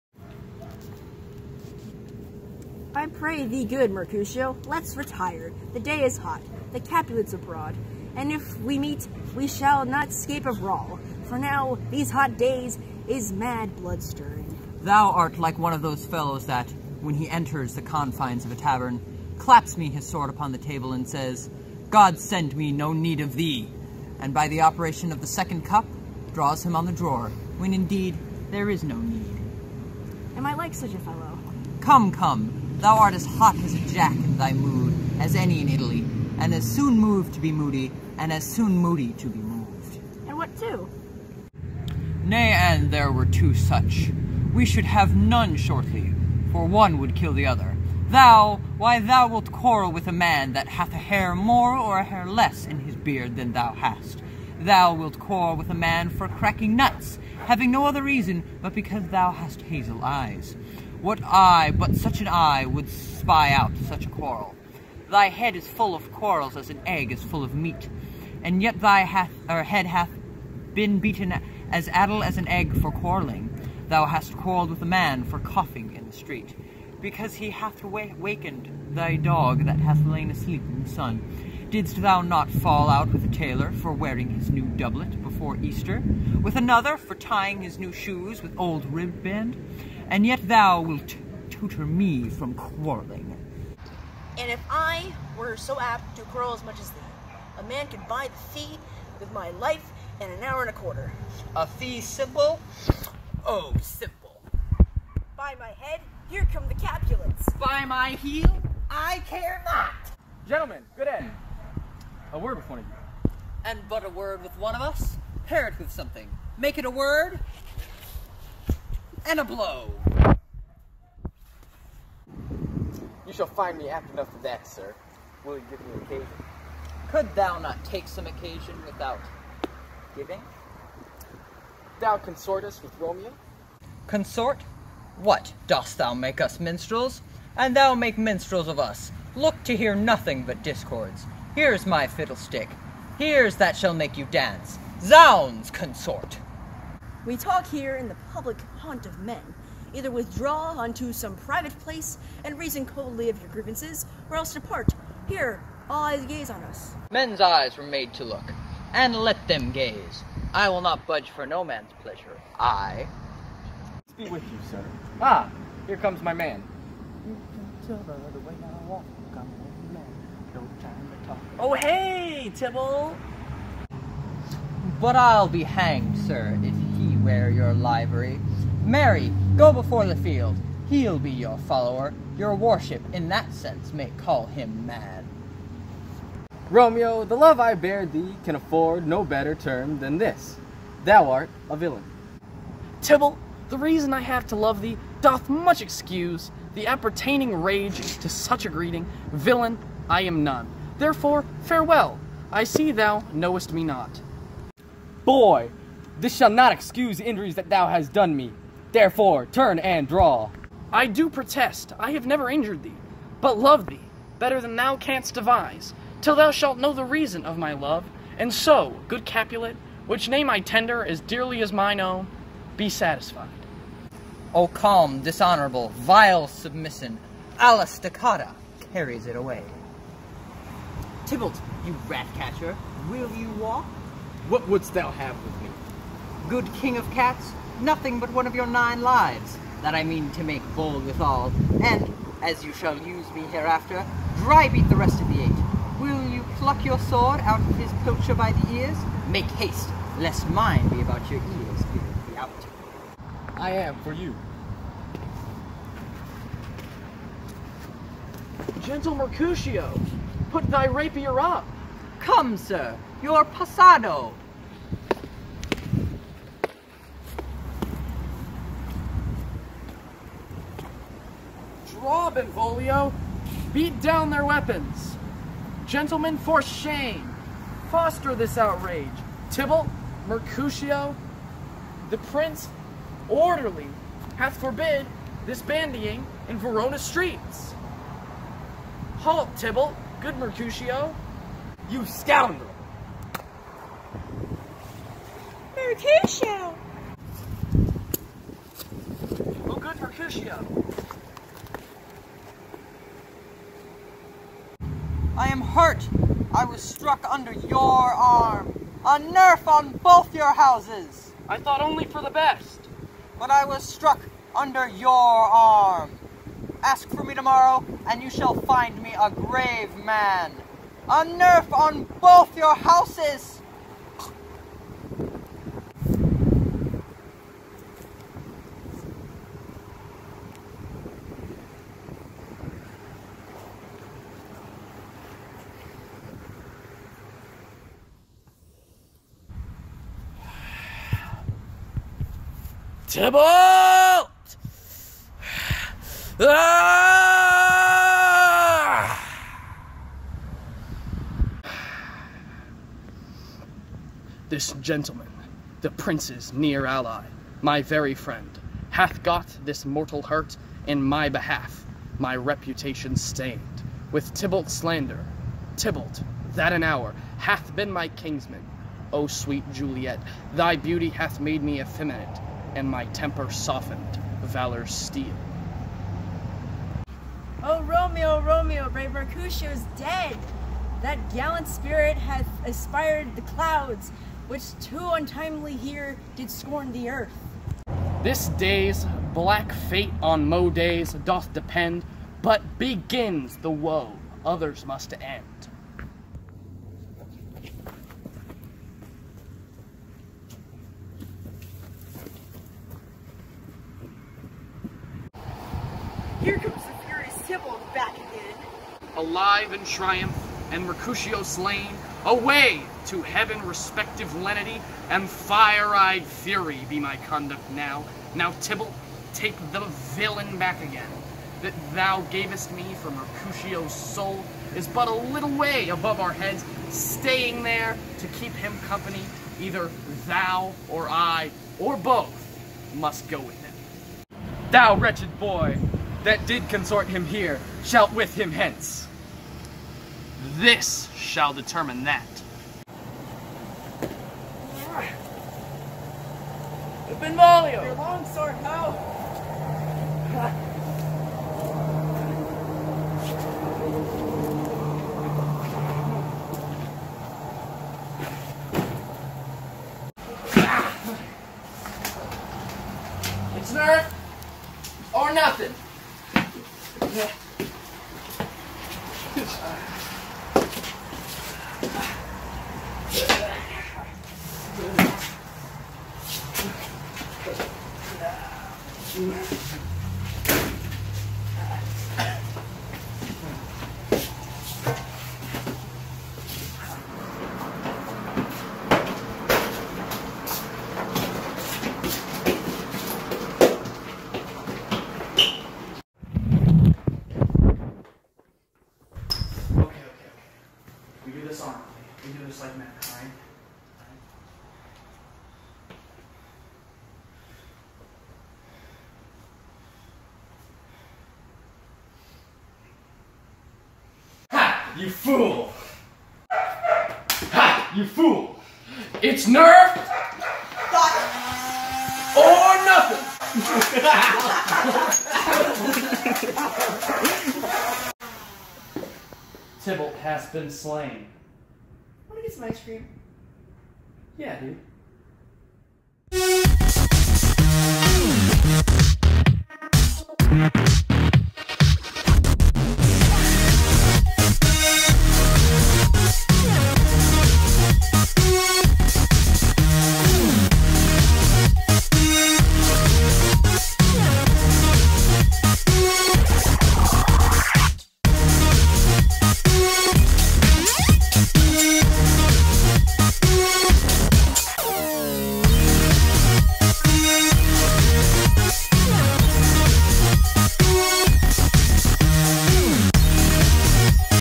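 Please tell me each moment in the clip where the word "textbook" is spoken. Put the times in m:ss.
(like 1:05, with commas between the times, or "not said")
not said.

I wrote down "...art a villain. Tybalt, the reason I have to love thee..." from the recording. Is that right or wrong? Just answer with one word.
right.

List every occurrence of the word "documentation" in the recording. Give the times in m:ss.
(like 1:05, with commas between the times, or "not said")
not said.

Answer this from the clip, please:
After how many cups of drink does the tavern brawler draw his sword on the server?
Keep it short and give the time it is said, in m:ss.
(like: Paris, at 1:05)
second cup, at 0:25.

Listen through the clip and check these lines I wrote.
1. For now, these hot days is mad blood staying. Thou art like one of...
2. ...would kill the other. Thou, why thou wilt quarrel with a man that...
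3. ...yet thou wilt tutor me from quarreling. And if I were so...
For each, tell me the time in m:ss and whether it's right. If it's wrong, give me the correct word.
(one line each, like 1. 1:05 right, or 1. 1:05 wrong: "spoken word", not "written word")
1. 0:11 wrong: "stirring", not "staying"
2. 0:46 right
3. 1:30 right.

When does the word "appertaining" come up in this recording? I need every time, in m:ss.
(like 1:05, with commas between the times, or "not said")
3:16.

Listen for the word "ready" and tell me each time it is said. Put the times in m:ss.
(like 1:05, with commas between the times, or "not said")
not said.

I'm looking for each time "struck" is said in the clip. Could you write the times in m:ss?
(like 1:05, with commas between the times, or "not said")
5:06, 5:13.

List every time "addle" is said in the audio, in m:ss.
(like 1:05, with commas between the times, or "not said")
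1:11.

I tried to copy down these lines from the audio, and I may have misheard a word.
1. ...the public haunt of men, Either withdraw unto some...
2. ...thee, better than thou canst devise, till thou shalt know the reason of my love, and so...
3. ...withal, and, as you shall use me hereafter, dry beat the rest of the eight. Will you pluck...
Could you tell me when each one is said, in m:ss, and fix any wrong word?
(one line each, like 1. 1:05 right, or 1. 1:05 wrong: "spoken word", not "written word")
1. 2:28 right
2. 3:33 right
3. 4:01 right.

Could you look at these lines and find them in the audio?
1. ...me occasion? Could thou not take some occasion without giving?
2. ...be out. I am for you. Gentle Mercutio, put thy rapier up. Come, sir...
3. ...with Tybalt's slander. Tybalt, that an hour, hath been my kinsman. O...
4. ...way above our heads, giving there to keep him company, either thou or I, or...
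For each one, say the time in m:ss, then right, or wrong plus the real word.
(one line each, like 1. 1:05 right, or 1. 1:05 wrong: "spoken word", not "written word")
1. 2:05 right
2. 4:12 right
3. 6:04 right
4. 7:05 wrong: "staying", not "giving".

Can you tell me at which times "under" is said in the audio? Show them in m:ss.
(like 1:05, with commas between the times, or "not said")
5:07, 5:14.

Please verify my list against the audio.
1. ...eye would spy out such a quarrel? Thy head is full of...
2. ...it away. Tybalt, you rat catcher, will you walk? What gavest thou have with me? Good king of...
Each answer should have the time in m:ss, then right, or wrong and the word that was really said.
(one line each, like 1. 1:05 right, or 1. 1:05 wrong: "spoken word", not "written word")
1. 1:02 right
2. 3:49 wrong: "wouldst", not "gavest".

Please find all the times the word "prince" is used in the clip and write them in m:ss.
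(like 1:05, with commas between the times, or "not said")
4:42, 5:55.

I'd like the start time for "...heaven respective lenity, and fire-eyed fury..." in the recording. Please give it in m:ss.
6:53.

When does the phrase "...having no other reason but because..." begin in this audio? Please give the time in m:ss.
0:57.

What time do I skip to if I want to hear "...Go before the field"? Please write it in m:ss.
2:59.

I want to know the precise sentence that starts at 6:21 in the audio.
That gallant spirit hath aspired the clouds, which too untimely here did scorn the earth.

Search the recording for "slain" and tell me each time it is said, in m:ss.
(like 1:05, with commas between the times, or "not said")
6:51, 8:50.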